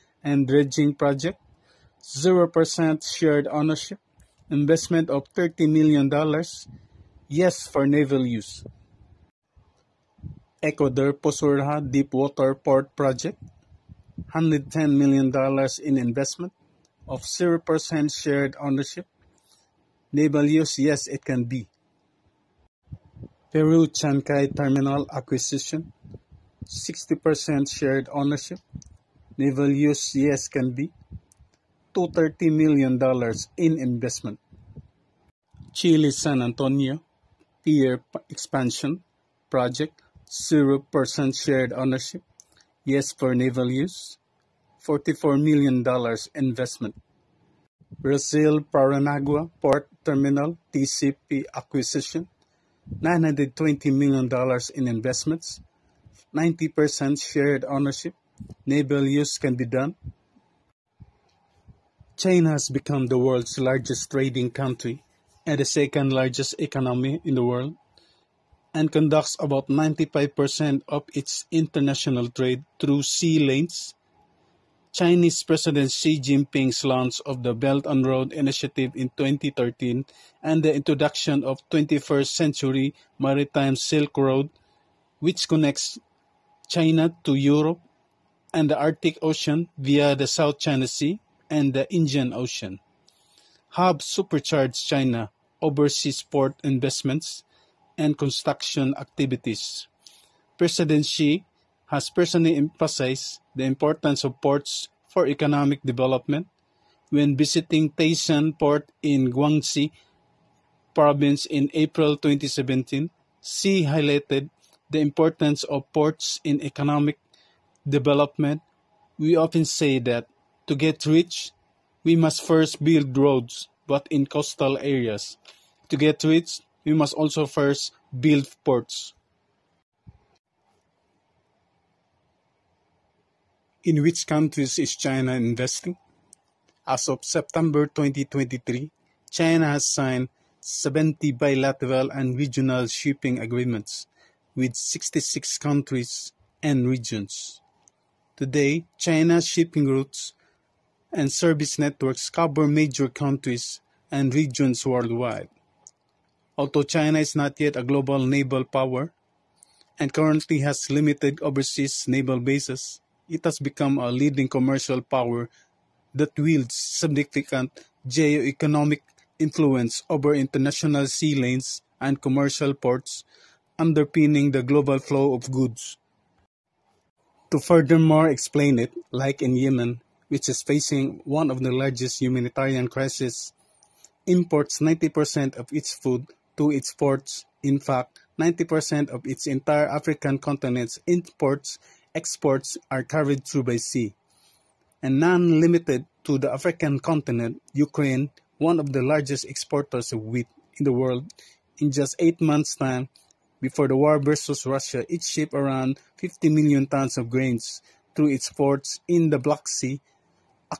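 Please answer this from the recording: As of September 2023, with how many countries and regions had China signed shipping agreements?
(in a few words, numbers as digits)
66.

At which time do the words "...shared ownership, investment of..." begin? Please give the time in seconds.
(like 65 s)
3 s.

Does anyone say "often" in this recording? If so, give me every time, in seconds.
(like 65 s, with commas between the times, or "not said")
119 s.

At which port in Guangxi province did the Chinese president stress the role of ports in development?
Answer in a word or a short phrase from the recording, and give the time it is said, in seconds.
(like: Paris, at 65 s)
Tieshan Port, at 107 s.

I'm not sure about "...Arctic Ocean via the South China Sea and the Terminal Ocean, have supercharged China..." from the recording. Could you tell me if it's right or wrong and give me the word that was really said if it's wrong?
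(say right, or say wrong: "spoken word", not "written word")
wrong: "Indian", not "Terminal".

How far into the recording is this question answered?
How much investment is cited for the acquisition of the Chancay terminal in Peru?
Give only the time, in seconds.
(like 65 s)
31 s.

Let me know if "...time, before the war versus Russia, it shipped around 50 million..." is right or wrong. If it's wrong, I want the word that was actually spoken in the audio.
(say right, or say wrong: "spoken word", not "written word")
right.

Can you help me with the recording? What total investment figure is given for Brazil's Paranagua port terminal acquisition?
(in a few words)
$920 million.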